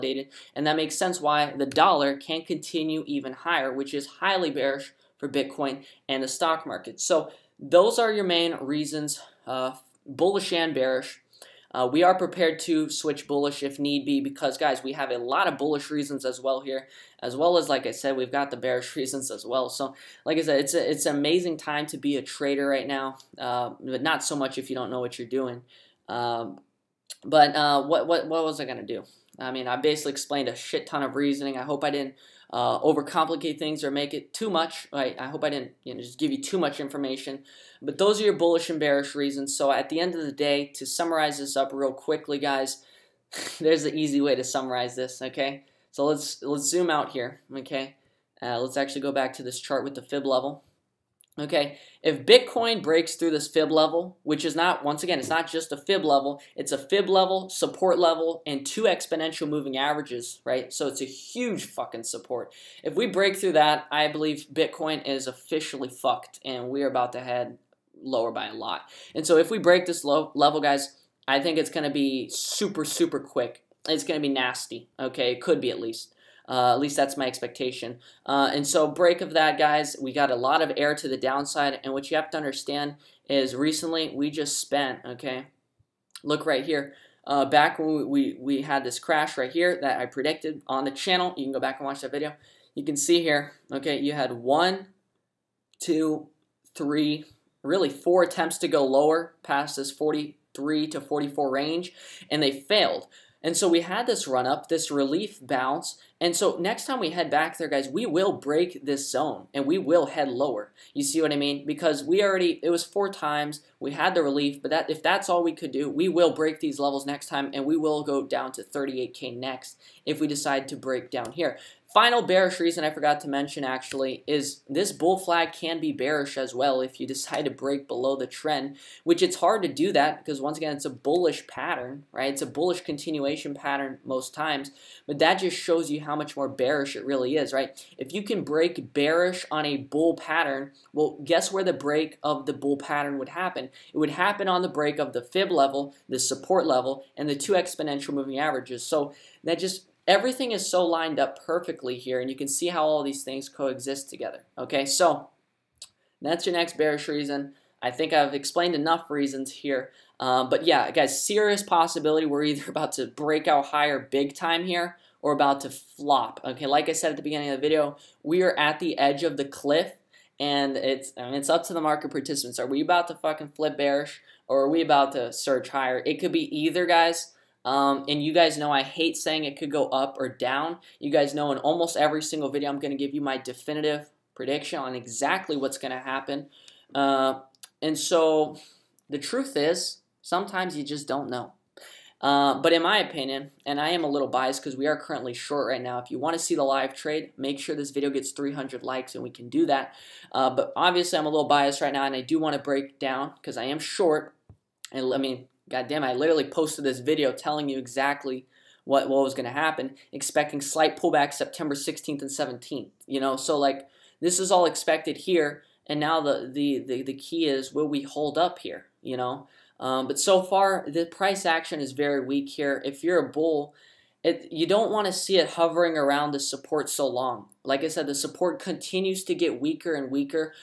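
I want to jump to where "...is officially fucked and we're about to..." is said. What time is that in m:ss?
1:05.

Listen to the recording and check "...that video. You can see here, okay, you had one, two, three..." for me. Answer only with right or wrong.
right.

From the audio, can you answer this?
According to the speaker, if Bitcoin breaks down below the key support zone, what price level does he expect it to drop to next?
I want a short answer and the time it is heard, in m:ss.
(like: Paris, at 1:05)
38K, at 1:58.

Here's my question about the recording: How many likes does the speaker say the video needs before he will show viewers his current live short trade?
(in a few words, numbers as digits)
300.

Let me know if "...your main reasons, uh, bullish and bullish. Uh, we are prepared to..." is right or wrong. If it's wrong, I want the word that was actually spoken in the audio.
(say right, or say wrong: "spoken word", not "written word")
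wrong: "bearish", not "bullish".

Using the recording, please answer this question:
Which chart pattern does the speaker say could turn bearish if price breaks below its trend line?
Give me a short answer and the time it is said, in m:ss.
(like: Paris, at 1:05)
bull flag, at 2:04.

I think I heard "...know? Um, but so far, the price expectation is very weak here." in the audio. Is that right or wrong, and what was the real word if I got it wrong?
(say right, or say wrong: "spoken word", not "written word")
wrong: "action", not "expectation".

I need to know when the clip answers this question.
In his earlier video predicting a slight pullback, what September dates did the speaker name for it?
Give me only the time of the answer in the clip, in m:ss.
3:31.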